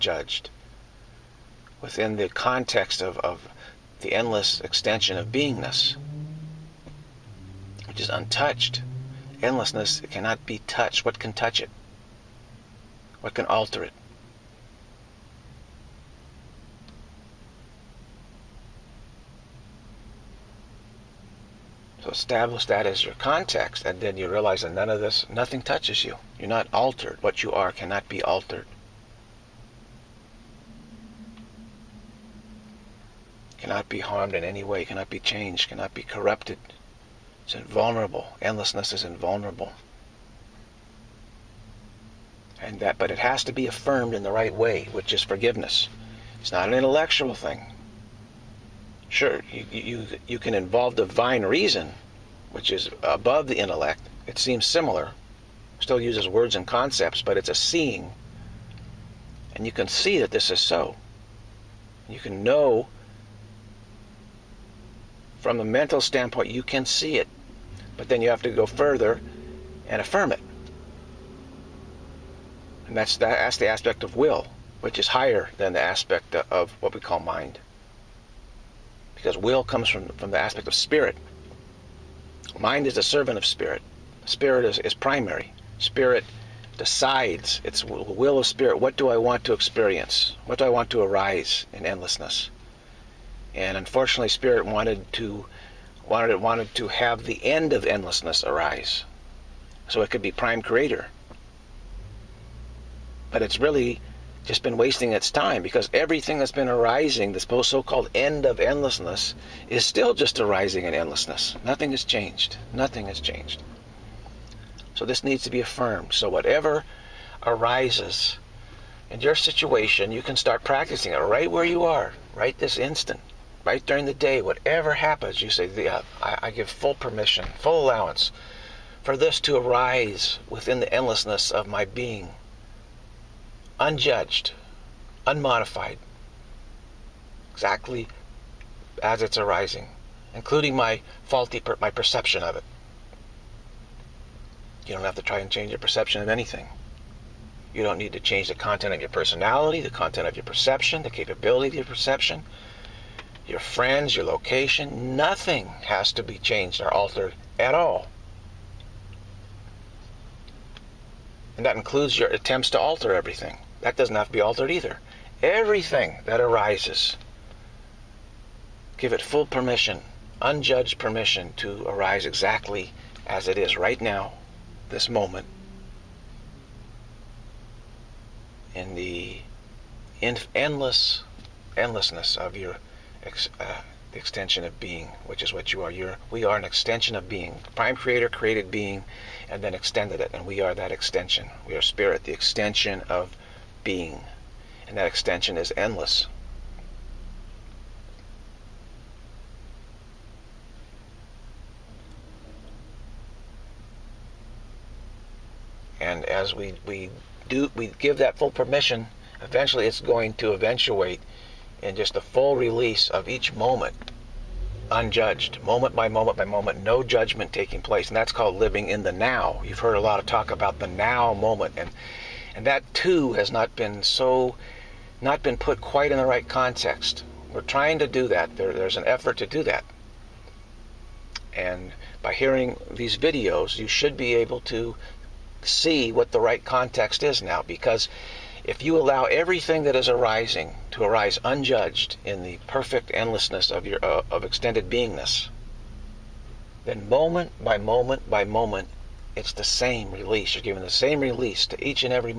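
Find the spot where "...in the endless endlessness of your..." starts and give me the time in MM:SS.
02:58.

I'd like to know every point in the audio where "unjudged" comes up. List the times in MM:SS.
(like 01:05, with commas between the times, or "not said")
02:13, 02:50, 03:34, 04:01.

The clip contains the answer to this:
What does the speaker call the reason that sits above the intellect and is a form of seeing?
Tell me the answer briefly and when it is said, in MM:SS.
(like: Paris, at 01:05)
Divine reason, at 00:50.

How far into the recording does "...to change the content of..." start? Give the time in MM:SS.
02:28.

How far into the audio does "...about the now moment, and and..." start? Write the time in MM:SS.
03:40.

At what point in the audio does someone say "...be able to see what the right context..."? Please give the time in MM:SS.
03:54.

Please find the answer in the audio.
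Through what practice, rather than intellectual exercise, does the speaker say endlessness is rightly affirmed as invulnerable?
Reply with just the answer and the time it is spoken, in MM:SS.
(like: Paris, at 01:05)
Forgiveness, at 00:45.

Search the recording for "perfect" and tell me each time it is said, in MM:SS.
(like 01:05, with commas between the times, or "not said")
04:02.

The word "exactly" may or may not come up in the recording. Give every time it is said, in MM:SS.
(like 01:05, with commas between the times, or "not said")
02:17, 02:52.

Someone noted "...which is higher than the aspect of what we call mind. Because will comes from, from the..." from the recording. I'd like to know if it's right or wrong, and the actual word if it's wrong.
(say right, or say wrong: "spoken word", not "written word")
right.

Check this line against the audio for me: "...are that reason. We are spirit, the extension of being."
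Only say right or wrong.
wrong.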